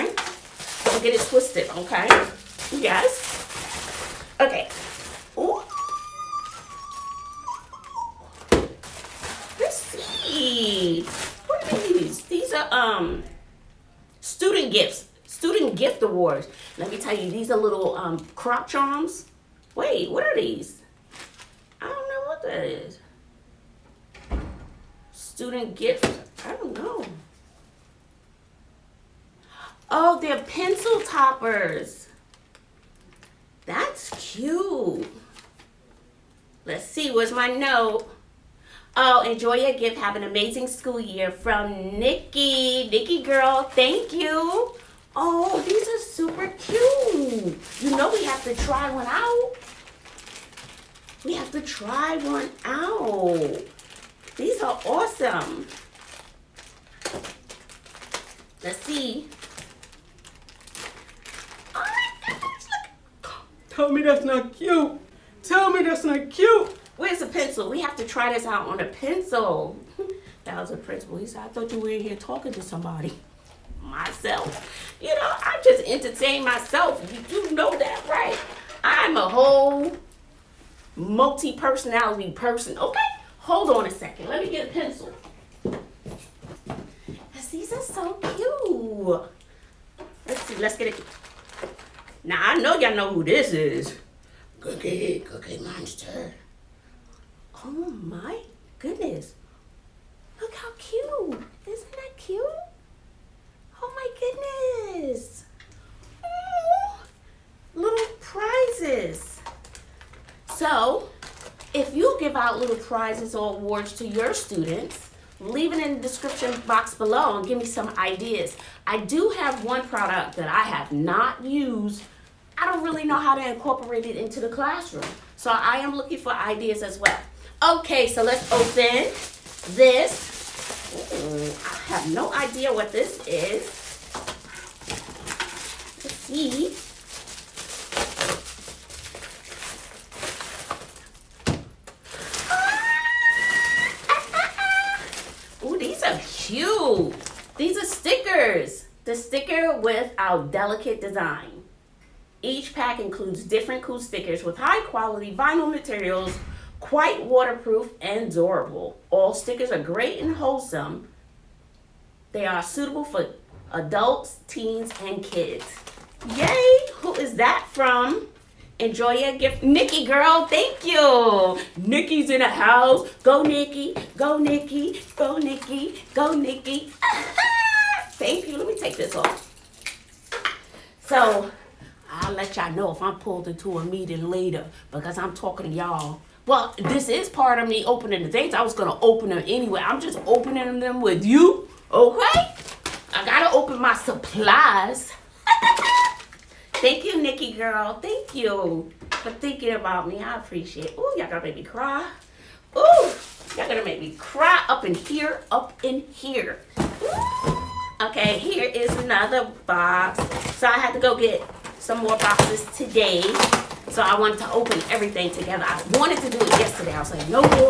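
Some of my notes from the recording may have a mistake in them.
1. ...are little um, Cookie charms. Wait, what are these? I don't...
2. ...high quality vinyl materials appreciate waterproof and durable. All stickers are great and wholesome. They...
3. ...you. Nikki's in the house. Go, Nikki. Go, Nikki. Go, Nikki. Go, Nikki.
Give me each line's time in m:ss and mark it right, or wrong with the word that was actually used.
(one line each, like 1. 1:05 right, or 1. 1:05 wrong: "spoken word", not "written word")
1. 0:17 wrong: "Croc", not "Cookie"
2. 2:34 wrong: "quite", not "appreciate"
3. 2:50 right.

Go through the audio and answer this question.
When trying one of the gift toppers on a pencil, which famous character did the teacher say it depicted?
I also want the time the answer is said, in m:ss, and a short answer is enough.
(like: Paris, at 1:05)
Cookie Monster, at 1:35.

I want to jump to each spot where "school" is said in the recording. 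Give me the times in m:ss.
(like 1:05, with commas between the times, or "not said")
0:40.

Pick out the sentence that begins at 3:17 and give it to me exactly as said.
Thank you for thinking about me.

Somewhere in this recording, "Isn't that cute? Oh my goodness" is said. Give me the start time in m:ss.
1:41.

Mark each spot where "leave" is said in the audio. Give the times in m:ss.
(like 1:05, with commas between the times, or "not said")
1:55.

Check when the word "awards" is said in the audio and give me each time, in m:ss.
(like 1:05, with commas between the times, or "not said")
0:16, 1:53.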